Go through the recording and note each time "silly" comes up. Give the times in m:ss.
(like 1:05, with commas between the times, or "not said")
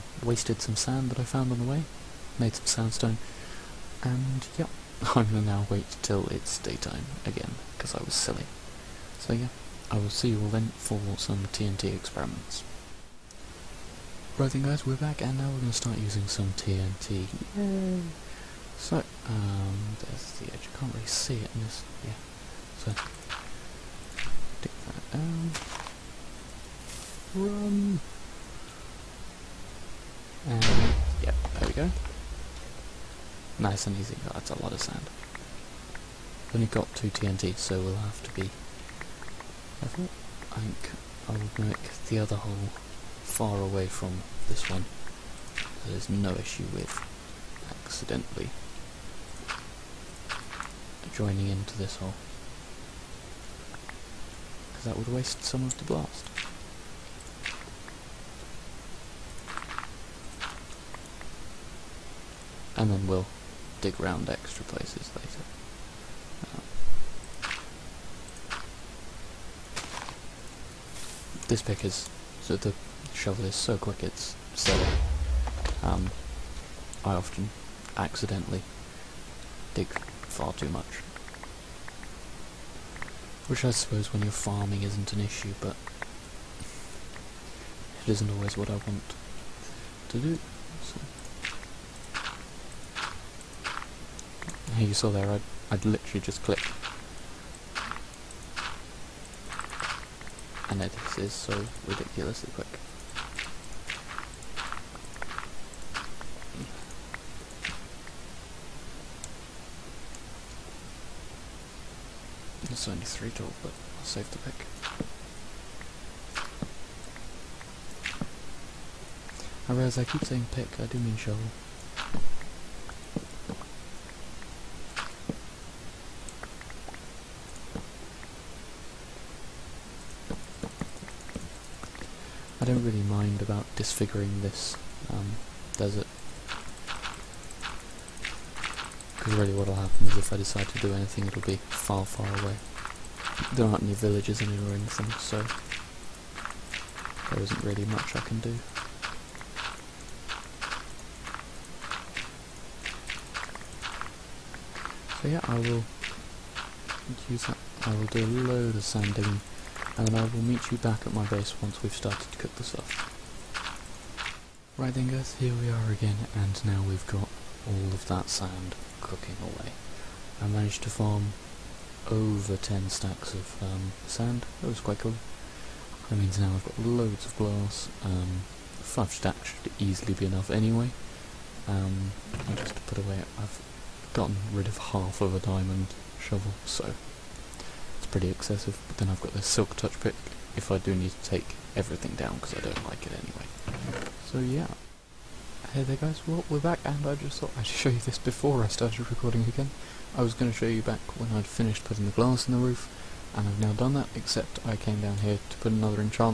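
0:08, 1:14.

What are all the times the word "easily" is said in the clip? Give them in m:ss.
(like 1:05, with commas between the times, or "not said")
2:59.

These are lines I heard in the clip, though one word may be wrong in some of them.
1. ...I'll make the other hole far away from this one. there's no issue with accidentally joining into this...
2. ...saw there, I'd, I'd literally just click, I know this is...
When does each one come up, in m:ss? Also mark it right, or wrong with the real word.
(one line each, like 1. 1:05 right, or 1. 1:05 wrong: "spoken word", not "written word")
1. 0:41 right
2. 1:34 right.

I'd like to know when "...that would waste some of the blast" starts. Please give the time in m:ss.
0:54.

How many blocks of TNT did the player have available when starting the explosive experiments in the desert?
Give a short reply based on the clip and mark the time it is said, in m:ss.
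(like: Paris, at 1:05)
2, at 0:36.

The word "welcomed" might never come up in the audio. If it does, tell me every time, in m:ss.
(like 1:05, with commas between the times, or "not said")
not said.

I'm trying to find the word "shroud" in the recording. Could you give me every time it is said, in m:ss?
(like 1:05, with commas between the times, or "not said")
not said.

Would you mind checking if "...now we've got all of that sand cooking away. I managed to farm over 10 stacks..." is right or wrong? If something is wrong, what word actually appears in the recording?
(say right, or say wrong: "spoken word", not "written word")
right.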